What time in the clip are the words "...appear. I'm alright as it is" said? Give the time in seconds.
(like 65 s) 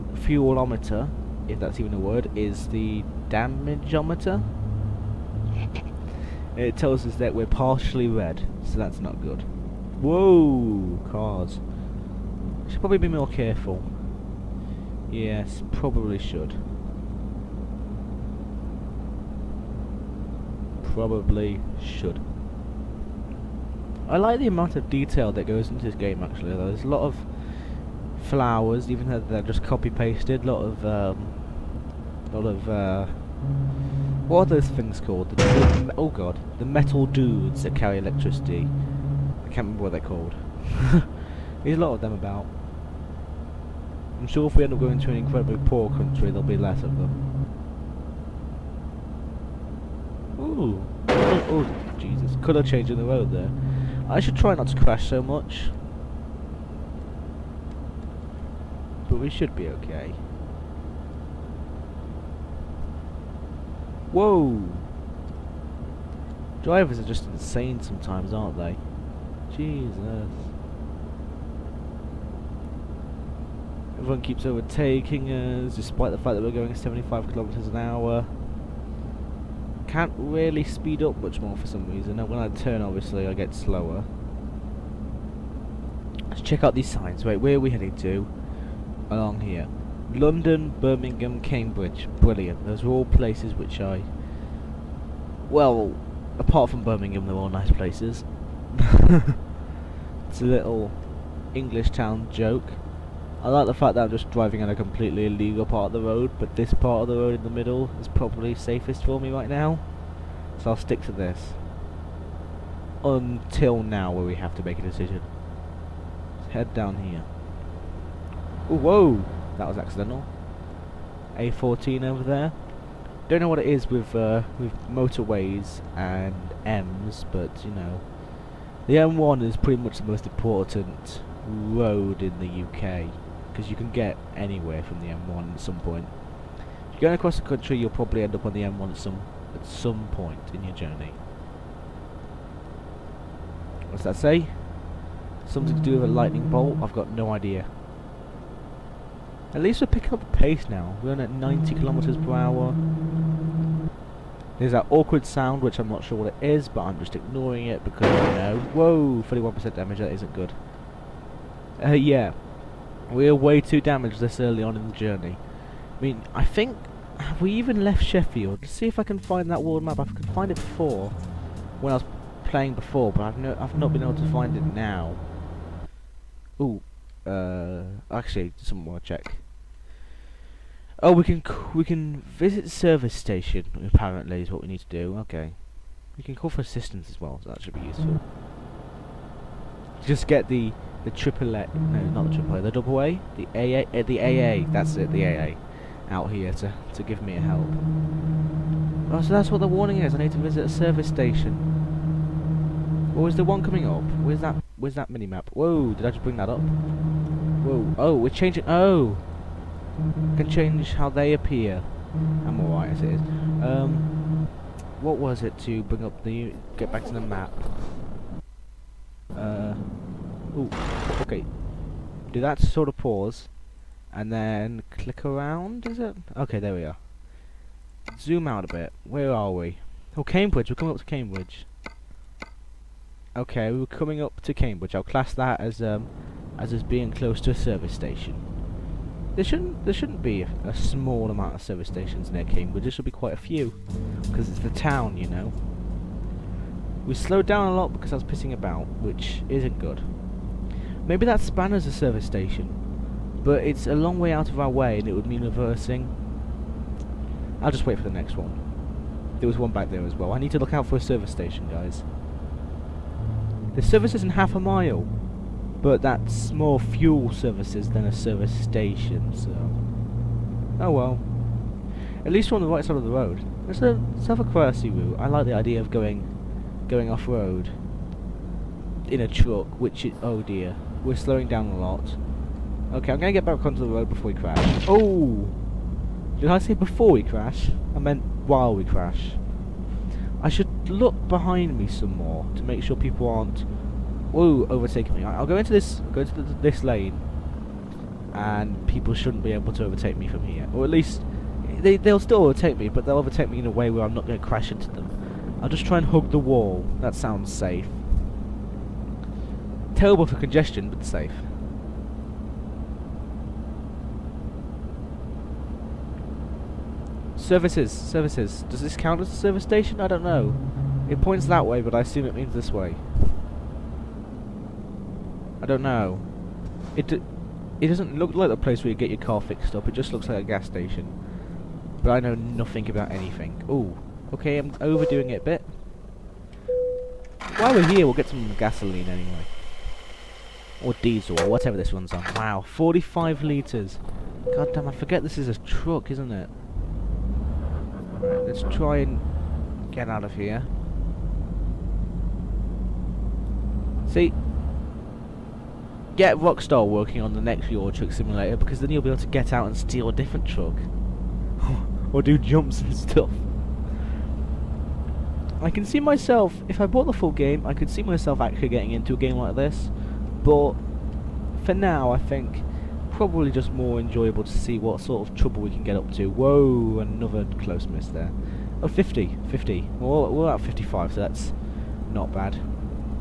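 211 s.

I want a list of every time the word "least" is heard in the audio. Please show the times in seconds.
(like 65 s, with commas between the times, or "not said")
149 s, 272 s, 300 s.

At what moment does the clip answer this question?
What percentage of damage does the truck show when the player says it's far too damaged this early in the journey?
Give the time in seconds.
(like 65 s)
159 s.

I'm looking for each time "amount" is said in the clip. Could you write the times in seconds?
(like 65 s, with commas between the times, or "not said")
24 s, 241 s.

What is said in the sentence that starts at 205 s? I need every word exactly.
Whoa, did I just bring that up?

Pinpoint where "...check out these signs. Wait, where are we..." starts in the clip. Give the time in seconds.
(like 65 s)
86 s.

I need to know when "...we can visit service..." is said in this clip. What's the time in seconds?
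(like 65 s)
181 s.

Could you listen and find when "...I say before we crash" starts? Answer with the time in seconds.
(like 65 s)
286 s.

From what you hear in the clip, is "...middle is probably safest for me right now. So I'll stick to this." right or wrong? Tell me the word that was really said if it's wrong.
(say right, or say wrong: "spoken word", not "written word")
right.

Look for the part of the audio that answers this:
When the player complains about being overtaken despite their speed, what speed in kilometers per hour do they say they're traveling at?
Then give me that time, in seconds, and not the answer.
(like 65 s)
76 s.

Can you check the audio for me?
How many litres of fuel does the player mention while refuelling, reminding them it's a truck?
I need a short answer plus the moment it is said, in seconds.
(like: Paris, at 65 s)
45, at 342 s.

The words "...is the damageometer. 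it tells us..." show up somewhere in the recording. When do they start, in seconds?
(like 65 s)
2 s.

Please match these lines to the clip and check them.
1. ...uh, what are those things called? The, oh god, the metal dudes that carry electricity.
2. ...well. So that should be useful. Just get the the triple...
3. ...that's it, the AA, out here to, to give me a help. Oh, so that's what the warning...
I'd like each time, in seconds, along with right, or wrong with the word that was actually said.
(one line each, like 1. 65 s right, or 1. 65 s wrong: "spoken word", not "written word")
1. 32 s right
2. 187 s right
3. 194 s right.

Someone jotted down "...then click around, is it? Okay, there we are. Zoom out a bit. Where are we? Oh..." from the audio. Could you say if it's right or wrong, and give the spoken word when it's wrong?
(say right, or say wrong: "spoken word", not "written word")
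right.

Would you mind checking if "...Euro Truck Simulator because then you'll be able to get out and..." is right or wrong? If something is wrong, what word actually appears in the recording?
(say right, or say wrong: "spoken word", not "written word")
right.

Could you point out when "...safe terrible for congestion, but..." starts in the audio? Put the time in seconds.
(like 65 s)
307 s.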